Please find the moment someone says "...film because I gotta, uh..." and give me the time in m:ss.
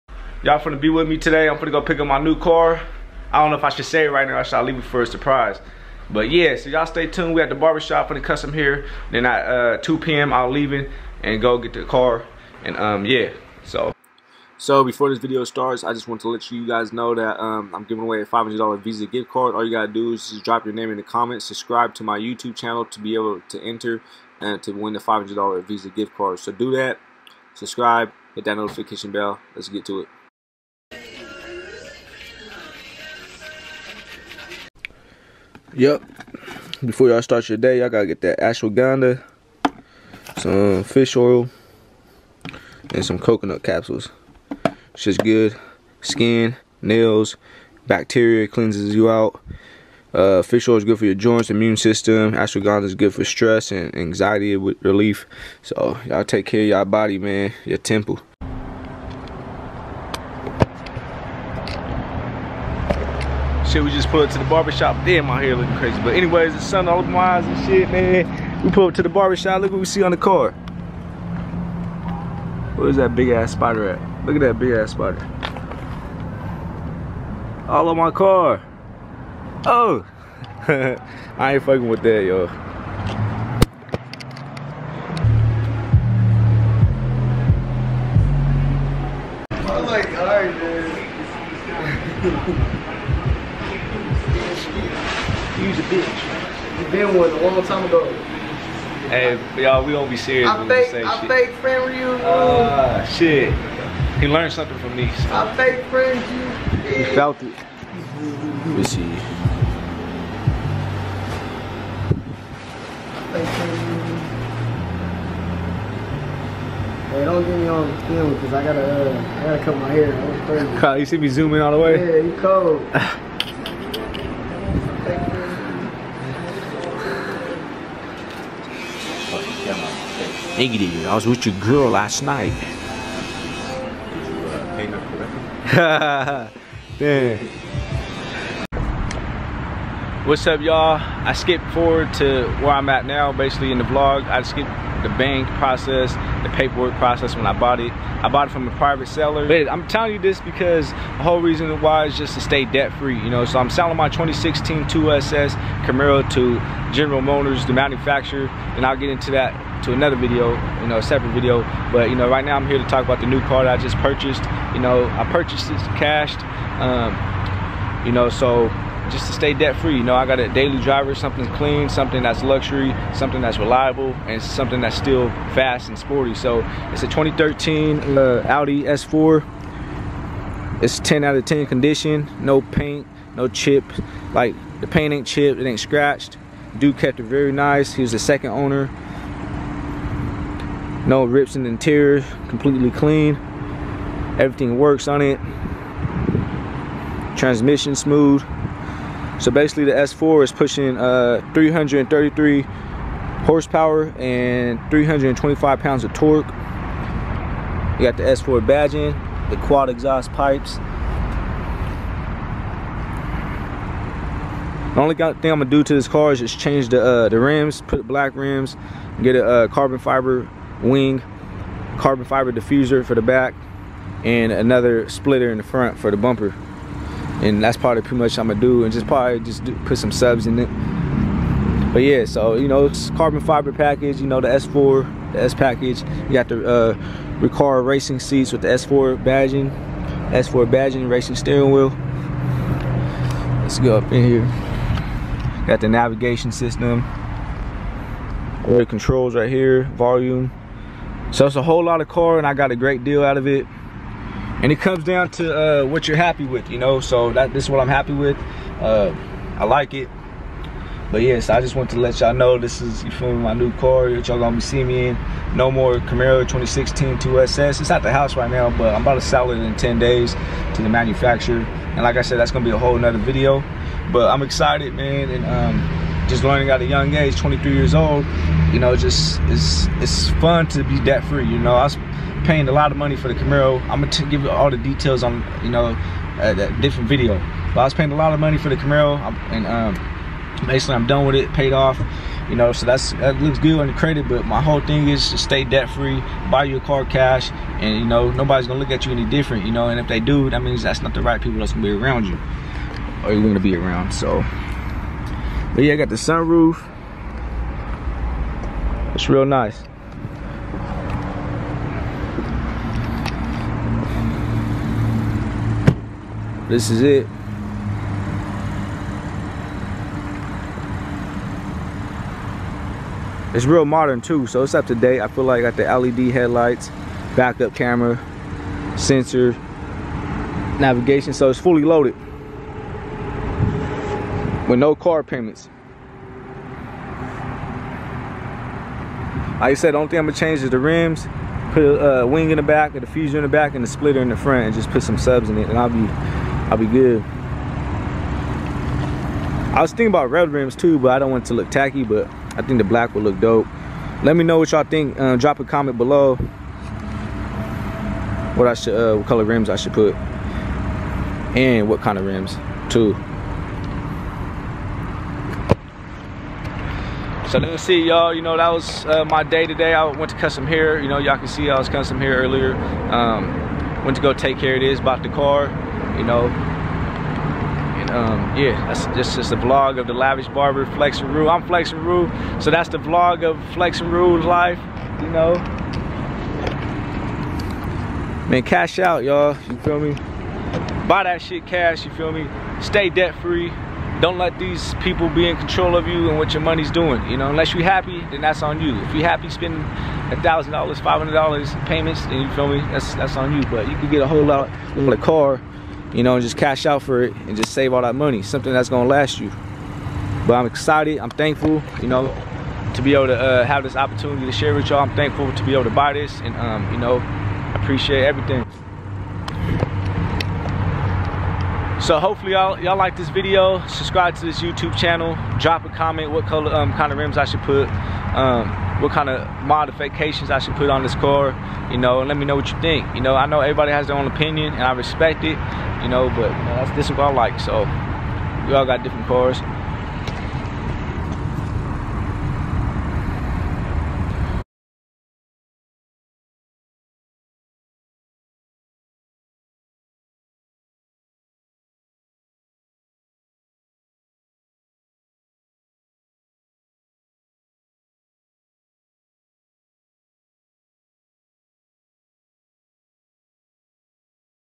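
1:58.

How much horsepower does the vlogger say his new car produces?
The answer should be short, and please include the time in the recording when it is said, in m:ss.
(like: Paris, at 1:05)
333, at 3:21.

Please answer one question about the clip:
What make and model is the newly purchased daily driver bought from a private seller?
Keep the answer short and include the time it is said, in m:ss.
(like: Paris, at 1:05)
Audi S4, at 2:58.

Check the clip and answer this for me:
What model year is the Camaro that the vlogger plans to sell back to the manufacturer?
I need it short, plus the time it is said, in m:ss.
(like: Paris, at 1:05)
2016, at 2:34.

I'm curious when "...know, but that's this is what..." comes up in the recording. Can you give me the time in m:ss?
7:16.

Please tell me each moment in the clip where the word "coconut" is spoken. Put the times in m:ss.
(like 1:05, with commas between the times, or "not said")
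0:43.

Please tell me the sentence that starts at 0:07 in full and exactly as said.
We at the barbershop for the custom here.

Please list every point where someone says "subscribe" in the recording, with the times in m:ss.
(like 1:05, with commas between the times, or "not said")
0:21, 0:27, 7:03.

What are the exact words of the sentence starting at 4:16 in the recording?
So that this is what I'm happy with.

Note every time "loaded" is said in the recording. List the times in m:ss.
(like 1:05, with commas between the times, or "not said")
5:31.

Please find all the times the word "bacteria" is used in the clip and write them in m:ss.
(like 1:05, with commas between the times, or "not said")
0:47.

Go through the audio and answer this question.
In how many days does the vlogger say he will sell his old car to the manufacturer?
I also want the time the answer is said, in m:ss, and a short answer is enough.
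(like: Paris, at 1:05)
10, at 4:29.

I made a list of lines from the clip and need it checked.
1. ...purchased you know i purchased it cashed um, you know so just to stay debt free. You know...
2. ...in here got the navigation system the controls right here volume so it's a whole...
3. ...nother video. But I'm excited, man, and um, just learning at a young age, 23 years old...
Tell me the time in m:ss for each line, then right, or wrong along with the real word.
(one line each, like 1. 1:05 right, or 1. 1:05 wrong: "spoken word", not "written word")
1. 2:43 right
2. 4:04 right
3. 4:32 right.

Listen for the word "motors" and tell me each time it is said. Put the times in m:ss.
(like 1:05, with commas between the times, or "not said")
2:37.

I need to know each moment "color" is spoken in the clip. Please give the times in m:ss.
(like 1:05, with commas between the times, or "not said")
5:59, 7:06.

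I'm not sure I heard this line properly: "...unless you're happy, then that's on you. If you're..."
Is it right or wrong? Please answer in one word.
right.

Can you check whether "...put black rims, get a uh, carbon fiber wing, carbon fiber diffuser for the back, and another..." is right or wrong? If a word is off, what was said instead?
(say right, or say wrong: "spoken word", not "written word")
right.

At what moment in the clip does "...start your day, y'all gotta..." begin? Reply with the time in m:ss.
0:37.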